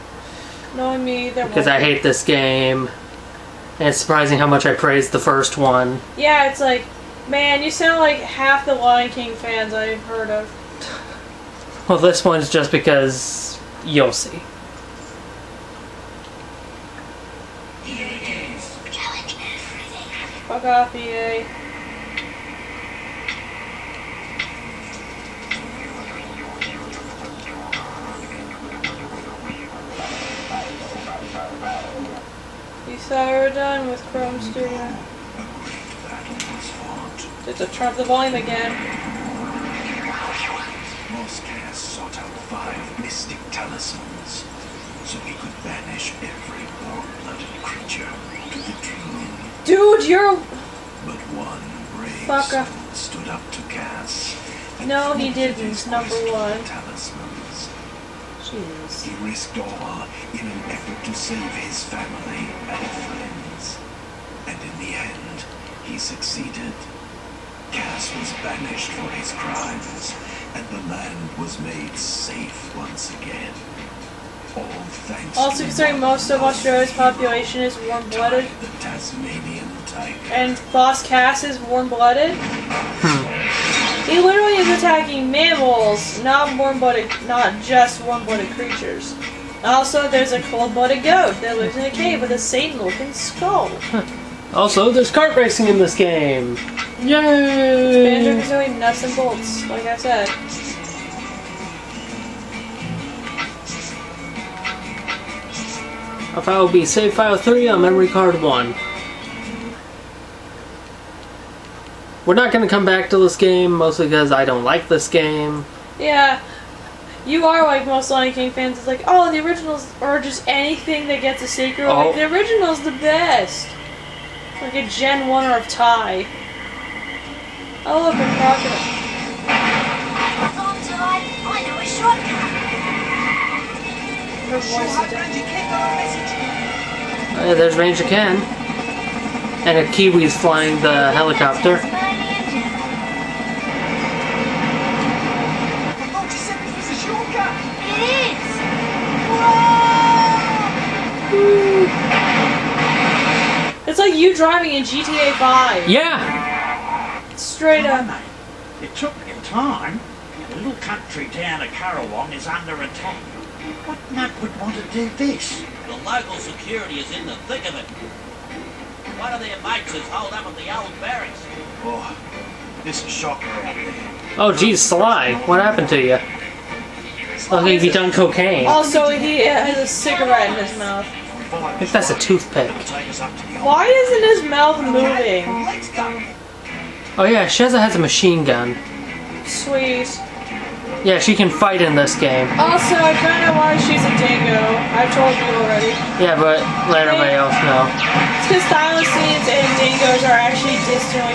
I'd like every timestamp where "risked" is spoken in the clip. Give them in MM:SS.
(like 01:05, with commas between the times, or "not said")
00:59.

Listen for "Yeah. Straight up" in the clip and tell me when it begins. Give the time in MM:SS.
02:35.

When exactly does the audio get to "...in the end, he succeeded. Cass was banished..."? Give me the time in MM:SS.
01:04.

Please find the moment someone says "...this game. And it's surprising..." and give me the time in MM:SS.
00:02.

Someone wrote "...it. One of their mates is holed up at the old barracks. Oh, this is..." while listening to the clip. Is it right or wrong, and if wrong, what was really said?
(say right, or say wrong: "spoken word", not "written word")
right.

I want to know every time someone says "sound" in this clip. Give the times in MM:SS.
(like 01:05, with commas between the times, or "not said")
00:07.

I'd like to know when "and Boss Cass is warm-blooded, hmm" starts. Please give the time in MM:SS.
01:20.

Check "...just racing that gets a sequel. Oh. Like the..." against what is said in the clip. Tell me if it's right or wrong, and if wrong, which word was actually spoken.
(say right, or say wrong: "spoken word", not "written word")
wrong: "anything", not "racing".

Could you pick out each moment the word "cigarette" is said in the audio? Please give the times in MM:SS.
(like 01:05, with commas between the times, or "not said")
02:59.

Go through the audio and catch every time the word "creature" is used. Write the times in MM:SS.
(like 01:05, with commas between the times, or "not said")
00:47, 01:28.